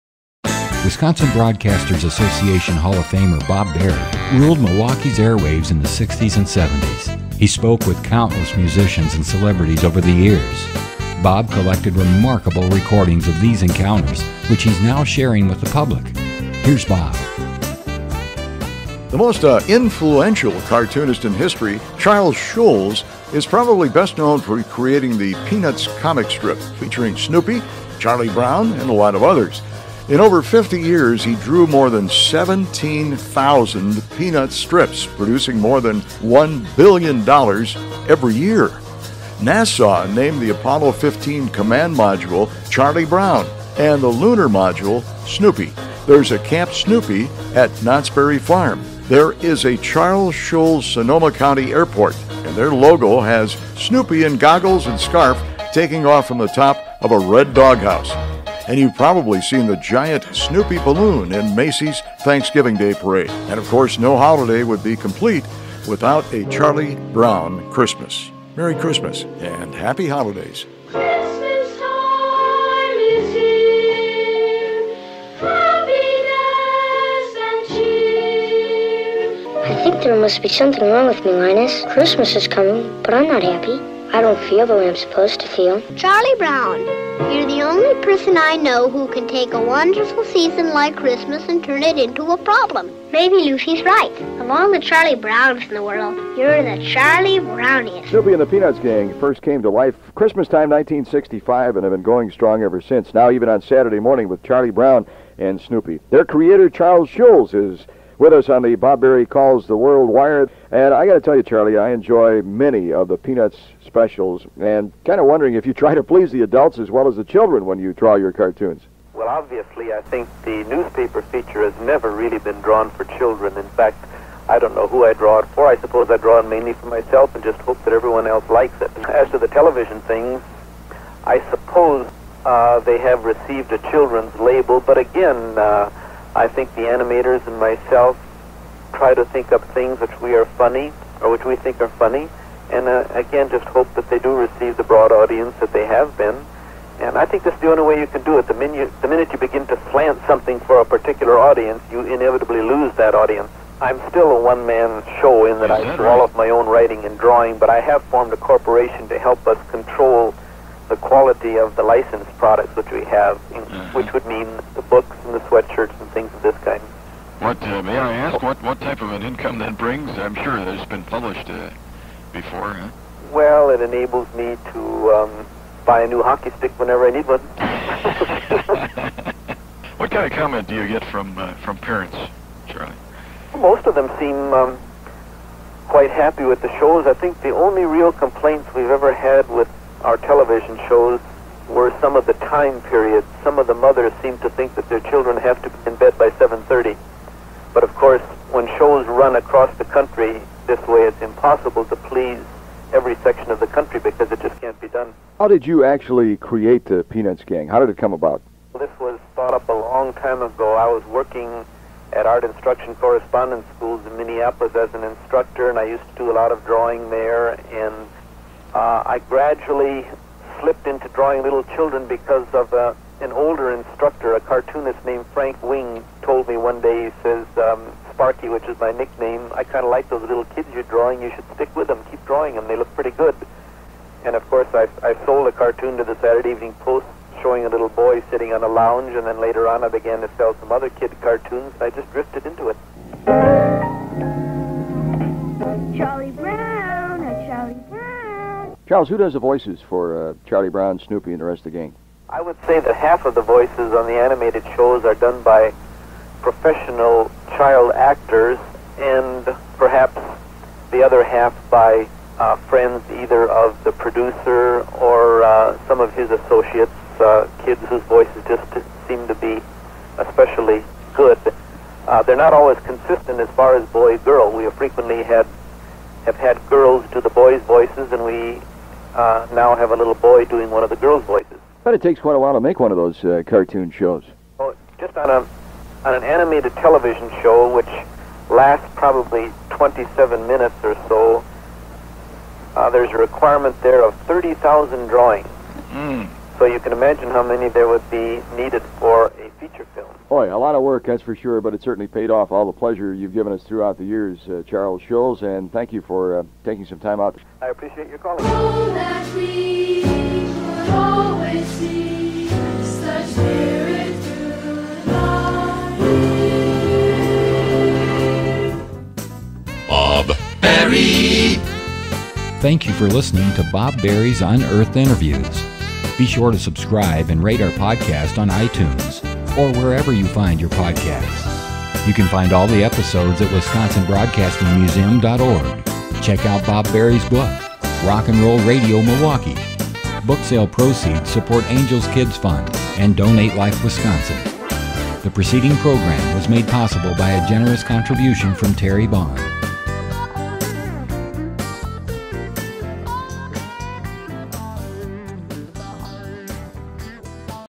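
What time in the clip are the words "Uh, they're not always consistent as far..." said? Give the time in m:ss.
4:32.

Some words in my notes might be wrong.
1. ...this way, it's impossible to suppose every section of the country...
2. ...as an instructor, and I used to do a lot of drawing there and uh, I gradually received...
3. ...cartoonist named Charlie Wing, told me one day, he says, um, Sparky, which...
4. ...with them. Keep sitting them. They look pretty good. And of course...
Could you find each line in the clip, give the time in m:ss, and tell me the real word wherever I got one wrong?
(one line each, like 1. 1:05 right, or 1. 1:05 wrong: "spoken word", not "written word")
1. 3:20 wrong: "please", not "suppose"
2. 3:34 wrong: "slipped", not "received"
3. 3:44 wrong: "Frank", not "Charlie"
4. 3:51 wrong: "drawing", not "sitting".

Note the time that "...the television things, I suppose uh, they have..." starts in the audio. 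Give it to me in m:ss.
2:09.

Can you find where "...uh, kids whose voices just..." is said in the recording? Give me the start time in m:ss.
4:27.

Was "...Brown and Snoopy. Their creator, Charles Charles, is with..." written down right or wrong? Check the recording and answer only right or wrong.
wrong.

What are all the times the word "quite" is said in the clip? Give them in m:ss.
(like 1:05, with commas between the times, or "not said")
3:05, 4:42.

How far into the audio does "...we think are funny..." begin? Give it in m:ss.
2:21.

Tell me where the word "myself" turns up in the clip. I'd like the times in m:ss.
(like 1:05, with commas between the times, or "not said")
2:06, 2:17.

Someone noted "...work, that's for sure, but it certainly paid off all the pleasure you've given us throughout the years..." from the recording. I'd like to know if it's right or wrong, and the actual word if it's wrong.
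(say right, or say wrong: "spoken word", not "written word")
right.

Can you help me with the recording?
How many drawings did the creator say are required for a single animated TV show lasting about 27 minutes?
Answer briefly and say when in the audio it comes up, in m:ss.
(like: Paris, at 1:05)
30,000, at 4:54.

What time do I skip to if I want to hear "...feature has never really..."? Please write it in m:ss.
2:01.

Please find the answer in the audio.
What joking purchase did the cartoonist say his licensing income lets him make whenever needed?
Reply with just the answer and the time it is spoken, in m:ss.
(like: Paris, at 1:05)
a new hockey stick, at 2:56.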